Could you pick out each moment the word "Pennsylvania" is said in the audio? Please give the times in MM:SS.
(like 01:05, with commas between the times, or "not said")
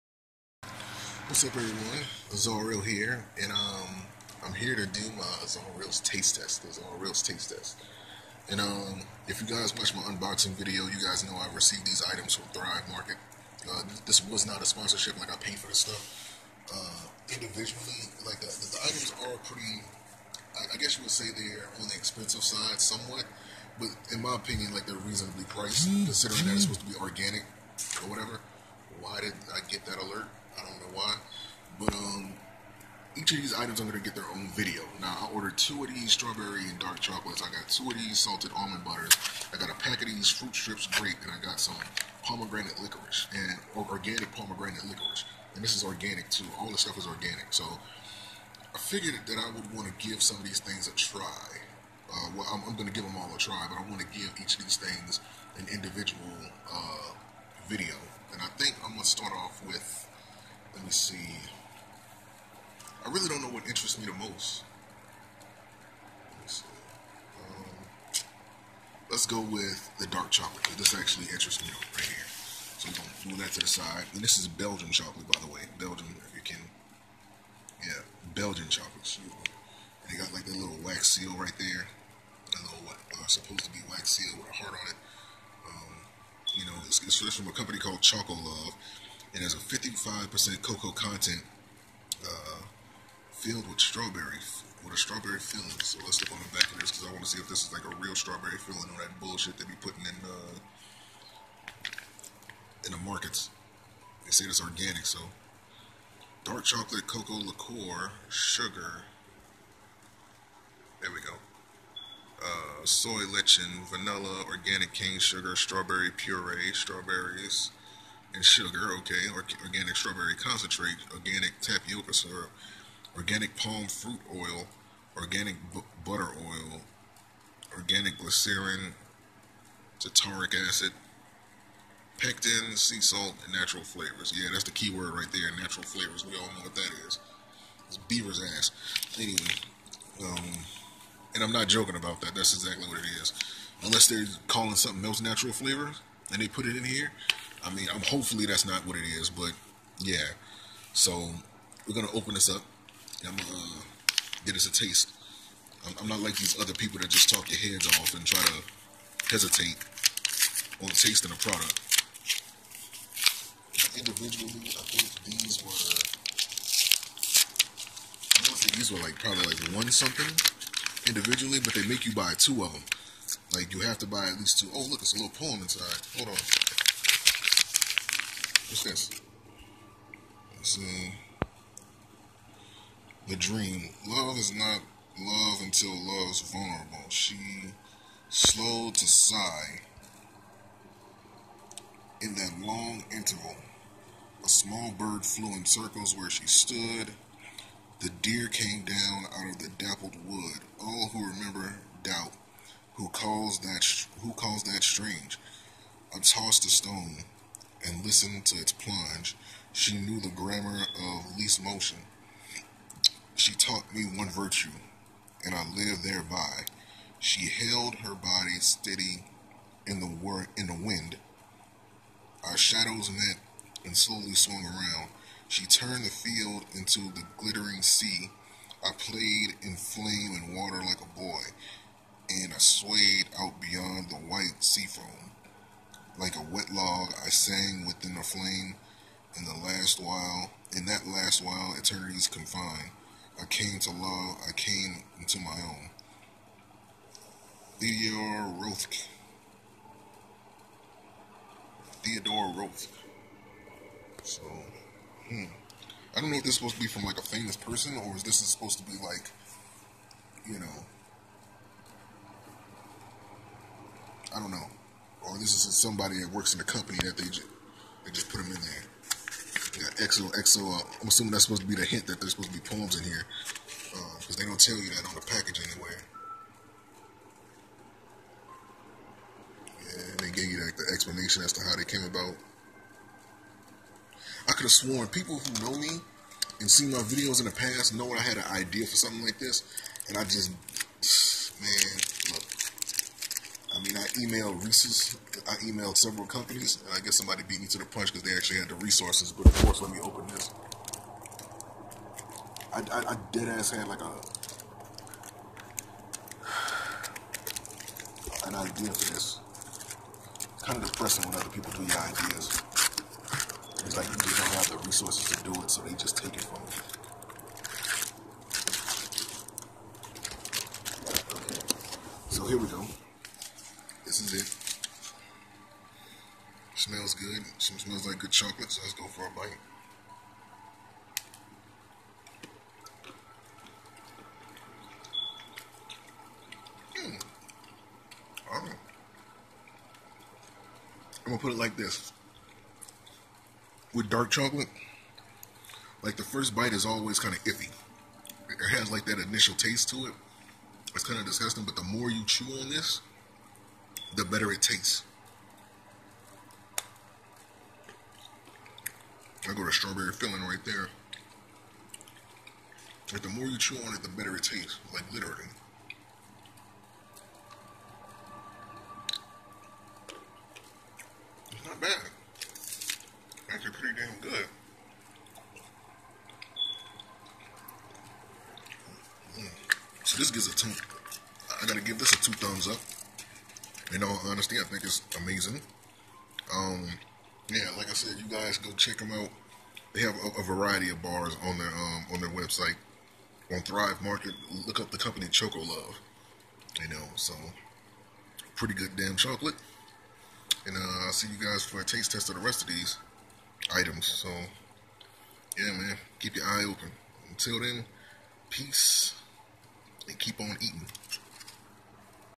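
not said.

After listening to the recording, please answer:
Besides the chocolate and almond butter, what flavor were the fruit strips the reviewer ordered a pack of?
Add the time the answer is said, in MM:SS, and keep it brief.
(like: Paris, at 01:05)
grape, at 00:40.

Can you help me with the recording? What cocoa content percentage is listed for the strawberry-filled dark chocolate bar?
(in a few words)
55%.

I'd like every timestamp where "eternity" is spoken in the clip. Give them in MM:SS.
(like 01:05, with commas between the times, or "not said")
04:01.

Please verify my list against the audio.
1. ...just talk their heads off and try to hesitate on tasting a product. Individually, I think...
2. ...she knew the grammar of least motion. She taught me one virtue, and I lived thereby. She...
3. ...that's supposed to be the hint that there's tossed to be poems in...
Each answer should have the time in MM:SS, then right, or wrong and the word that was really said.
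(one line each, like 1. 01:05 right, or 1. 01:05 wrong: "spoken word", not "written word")
1. 02:37 right
2. 03:29 right
3. 04:31 wrong: "supposed", not "tossed".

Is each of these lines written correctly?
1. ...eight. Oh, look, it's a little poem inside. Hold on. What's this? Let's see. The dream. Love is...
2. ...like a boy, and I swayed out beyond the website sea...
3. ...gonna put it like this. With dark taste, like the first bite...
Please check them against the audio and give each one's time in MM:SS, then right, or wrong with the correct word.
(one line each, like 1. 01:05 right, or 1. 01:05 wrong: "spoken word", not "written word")
1. 02:54 wrong: "two", not "eight"
2. 03:50 wrong: "white", not "website"
3. 05:41 wrong: "chocolate", not "taste".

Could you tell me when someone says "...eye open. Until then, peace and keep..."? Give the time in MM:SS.
06:46.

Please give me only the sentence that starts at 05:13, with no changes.
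It's like you just don't have the resources to do it, so they just take it from you.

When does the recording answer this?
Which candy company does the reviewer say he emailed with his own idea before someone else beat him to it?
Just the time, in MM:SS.
04:54.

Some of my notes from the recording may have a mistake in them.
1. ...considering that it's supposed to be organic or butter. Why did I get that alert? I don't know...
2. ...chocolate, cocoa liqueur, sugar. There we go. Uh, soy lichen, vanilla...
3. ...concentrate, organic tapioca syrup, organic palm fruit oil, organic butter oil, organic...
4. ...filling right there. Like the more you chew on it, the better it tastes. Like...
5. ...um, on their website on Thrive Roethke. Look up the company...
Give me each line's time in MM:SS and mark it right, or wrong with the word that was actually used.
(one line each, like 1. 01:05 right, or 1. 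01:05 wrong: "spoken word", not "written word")
1. 00:25 wrong: "whatever", not "butter"
2. 01:46 right
3. 02:00 right
4. 06:00 right
5. 06:31 wrong: "Market", not "Roethke".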